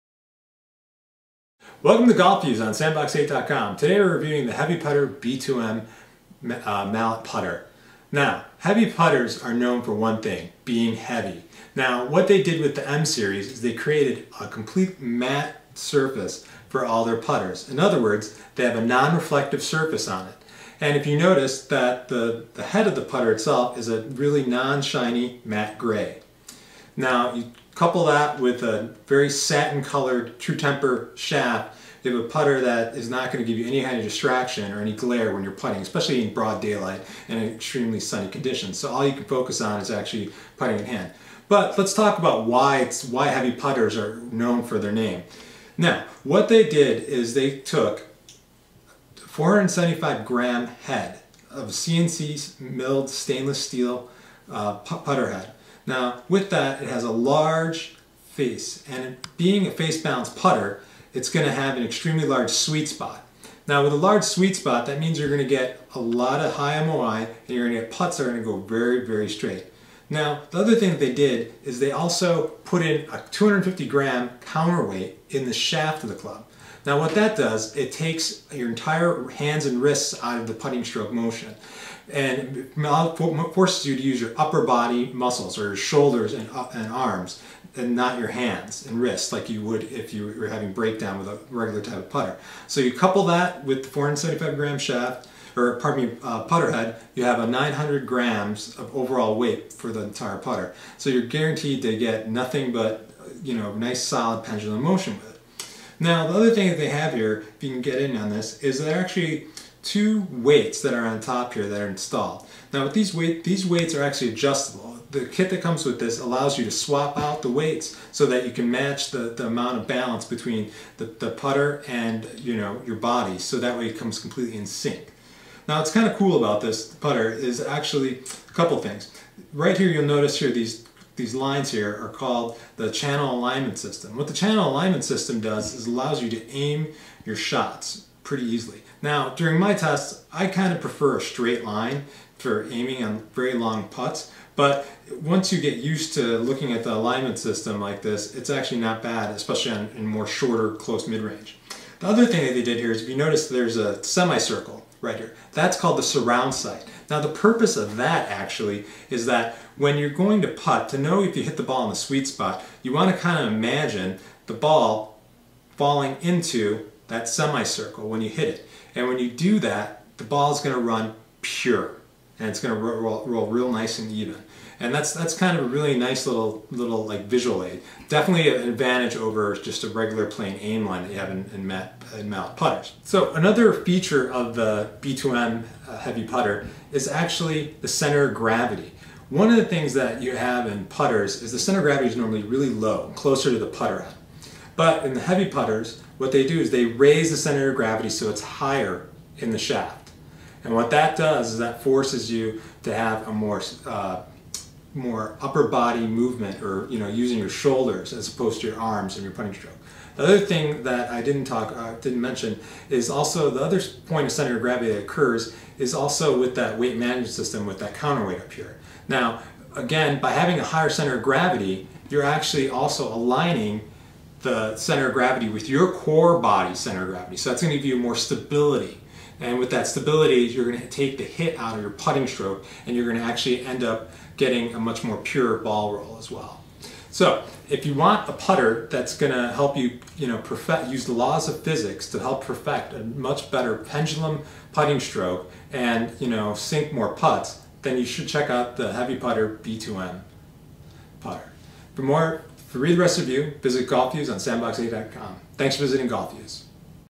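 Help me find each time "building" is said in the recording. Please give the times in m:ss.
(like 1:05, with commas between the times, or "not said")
not said.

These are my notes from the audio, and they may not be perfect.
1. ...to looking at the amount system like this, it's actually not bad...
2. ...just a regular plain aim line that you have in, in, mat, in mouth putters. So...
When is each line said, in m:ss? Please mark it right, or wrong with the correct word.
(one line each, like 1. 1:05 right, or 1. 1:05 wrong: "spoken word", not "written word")
1. 2:26 wrong: "alignment", not "amount"
2. 2:59 right.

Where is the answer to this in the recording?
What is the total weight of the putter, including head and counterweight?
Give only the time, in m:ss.
1:37.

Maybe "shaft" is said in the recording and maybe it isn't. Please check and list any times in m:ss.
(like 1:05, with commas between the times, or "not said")
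0:31, 1:15, 1:34, 3:19.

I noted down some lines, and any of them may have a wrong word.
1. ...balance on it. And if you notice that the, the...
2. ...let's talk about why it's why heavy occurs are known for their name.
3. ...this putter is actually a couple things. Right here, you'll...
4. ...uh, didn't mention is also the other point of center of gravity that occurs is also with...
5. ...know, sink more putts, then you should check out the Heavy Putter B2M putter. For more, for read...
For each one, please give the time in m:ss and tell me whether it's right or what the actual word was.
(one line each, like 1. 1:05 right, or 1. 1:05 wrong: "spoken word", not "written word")
1. 0:19 wrong: "surface", not "balance"
2. 0:41 wrong: "putters", not "occurs"
3. 2:06 right
4. 3:31 right
5. 4:06 right.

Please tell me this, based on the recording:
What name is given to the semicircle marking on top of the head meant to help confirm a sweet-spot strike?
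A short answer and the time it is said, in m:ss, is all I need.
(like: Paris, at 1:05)
Surround sight, at 2:36.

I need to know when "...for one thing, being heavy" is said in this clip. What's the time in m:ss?
0:09.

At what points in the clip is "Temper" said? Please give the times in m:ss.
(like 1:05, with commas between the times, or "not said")
0:30.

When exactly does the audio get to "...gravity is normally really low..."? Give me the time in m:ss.
3:11.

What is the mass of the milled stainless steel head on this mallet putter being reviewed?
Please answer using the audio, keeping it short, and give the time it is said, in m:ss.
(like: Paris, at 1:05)
475 grams, at 0:49.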